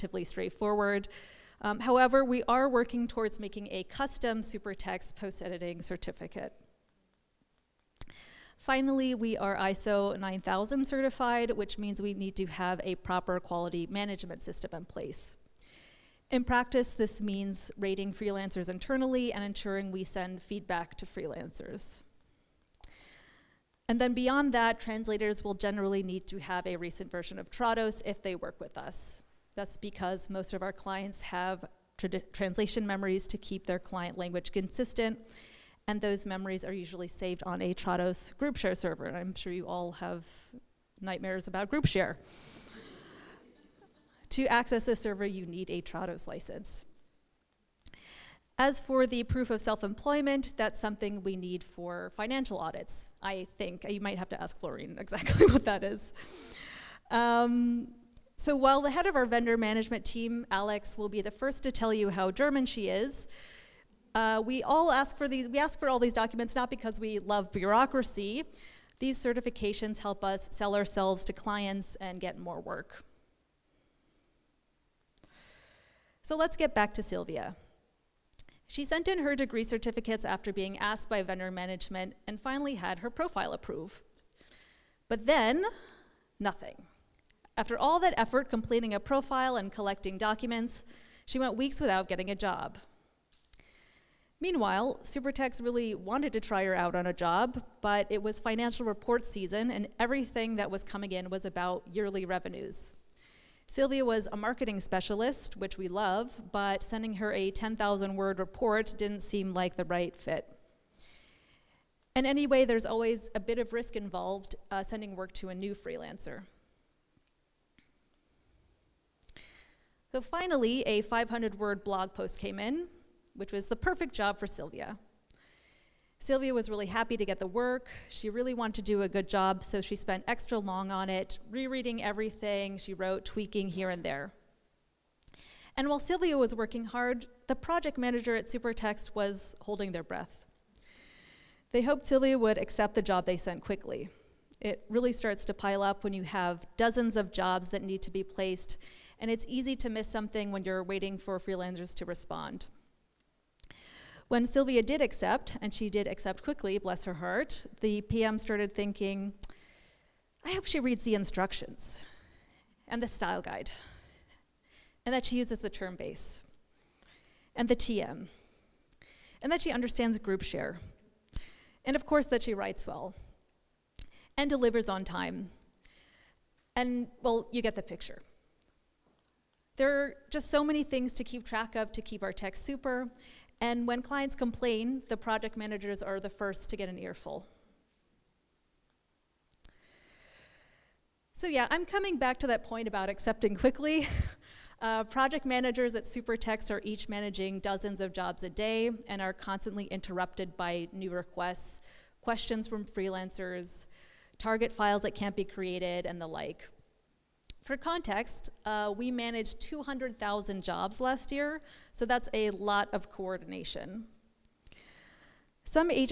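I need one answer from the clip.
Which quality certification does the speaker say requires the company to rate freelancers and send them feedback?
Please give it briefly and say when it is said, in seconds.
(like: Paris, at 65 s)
ISO 9000, at 9 s.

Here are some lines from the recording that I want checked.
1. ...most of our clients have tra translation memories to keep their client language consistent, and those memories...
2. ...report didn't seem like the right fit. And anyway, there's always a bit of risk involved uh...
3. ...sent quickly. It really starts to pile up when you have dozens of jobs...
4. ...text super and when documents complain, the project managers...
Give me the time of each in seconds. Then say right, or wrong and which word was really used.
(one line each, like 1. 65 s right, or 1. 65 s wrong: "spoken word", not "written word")
1. 30 s right
2. 108 s right
3. 143 s right
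4. 182 s wrong: "clients", not "documents".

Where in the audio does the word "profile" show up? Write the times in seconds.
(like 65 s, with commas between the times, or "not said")
83 s, 88 s.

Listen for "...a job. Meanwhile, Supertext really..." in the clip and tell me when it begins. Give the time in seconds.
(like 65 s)
92 s.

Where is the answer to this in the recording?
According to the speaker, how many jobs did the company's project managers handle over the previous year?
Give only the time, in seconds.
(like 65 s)
209 s.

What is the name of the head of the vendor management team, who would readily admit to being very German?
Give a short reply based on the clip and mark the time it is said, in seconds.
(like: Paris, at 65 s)
Alex, at 60 s.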